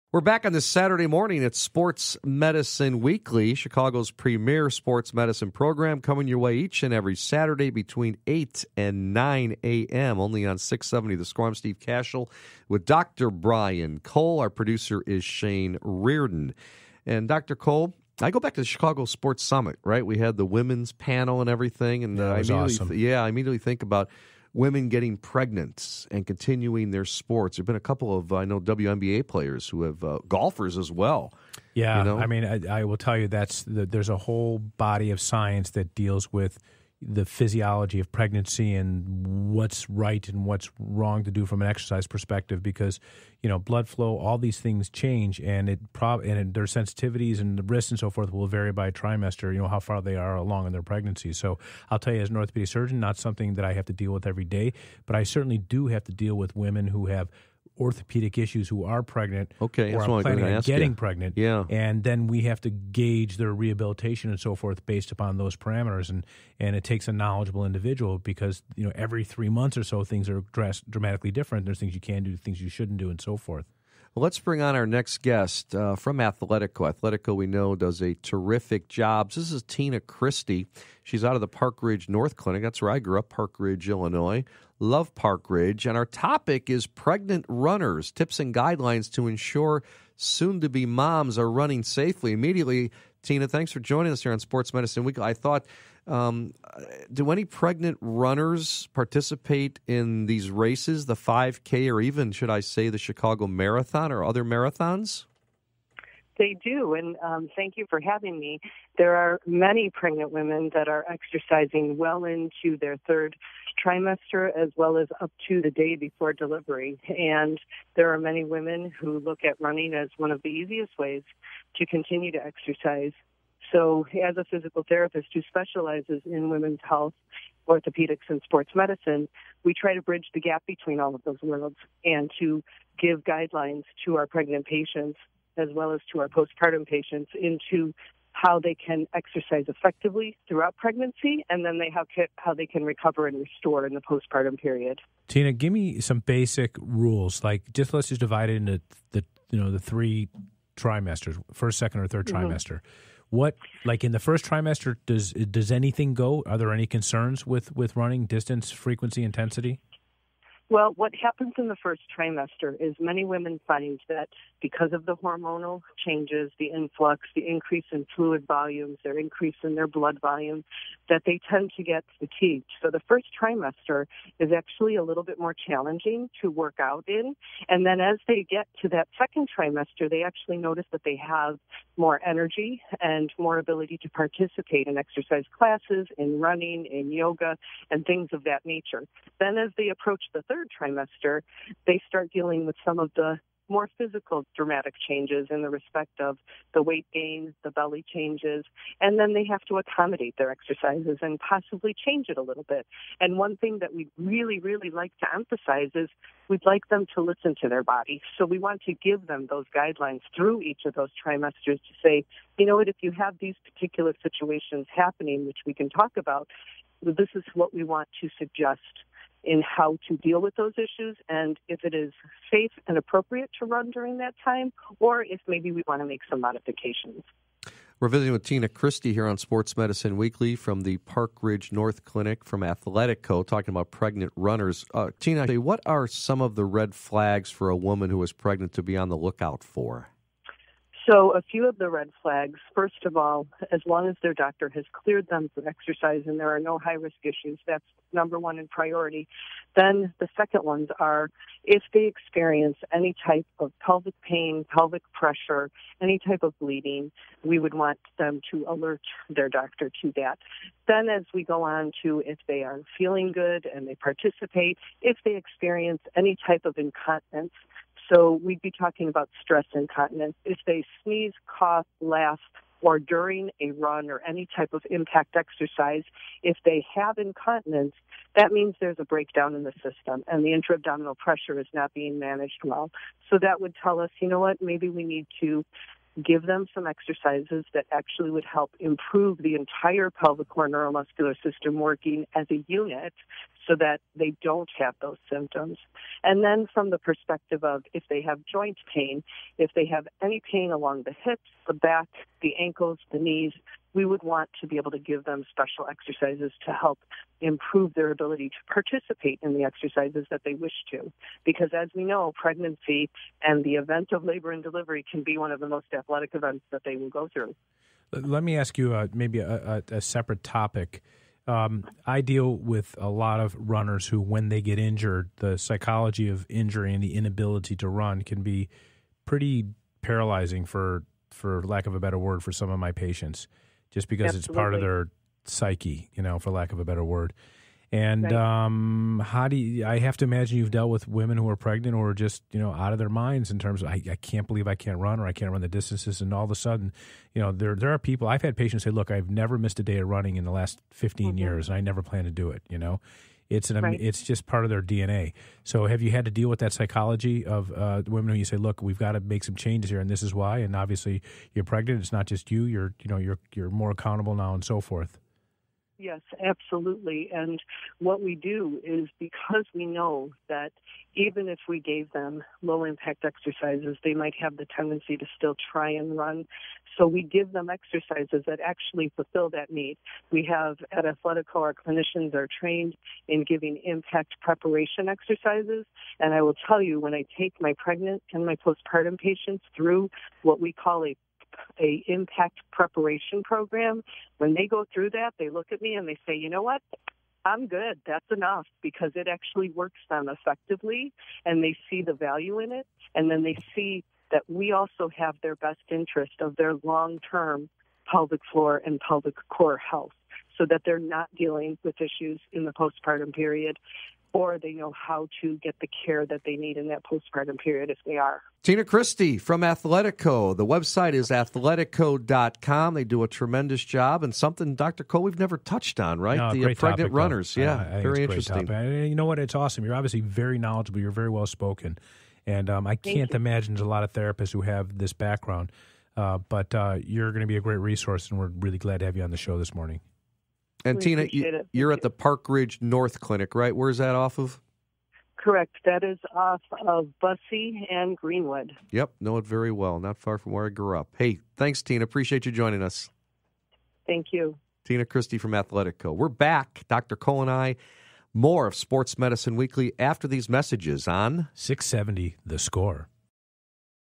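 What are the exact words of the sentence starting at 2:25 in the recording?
Tina, give me some basic rules.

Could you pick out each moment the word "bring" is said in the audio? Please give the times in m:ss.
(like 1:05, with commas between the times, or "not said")
1:14.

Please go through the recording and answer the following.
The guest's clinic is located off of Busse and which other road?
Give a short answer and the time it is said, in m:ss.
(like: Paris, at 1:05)
Greenwood, at 7:28.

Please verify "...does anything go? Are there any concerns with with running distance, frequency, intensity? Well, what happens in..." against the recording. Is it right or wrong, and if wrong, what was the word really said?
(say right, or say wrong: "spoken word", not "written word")
right.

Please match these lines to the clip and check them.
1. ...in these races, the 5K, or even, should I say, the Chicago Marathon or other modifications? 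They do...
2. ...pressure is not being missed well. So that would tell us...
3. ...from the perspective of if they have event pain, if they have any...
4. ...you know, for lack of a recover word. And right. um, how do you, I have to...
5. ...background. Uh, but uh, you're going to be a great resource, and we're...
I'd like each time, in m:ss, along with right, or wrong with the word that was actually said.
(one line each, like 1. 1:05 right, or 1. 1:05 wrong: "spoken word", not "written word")
1. 1:39 wrong: "marathons", not "modifications"
2. 4:41 wrong: "managed", not "missed"
3. 4:56 wrong: "joint", not "event"
4. 5:36 wrong: "better", not "recover"
5. 7:15 right.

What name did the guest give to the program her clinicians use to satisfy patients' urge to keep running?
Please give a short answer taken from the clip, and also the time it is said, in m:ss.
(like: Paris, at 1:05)
impact preparation program, at 6:32.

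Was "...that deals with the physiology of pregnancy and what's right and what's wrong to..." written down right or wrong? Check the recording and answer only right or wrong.
right.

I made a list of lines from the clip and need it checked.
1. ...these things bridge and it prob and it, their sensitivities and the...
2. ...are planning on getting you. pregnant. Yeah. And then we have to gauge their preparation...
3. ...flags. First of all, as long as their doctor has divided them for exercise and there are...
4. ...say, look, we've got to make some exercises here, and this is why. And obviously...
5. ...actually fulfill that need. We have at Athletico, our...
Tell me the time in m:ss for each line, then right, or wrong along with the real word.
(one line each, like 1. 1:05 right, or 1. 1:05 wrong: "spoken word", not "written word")
1. 0:44 wrong: "change", not "bridge"
2. 1:00 wrong: "rehabilitation", not "preparation"
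3. 4:02 wrong: "cleared", not "divided"
4. 5:58 wrong: "changes", not "exercises"
5. 6:18 right.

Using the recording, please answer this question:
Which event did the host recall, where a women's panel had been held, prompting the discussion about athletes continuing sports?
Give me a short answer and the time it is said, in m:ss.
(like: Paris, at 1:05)
Chicago Sports Summit, at 0:18.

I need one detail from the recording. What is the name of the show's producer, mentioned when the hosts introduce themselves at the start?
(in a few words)
Shane Reardon.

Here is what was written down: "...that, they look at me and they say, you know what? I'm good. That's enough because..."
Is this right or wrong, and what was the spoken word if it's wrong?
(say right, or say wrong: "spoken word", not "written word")
right.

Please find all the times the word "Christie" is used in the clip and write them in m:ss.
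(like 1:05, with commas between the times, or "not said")
1:20, 3:48, 6:58, 7:35.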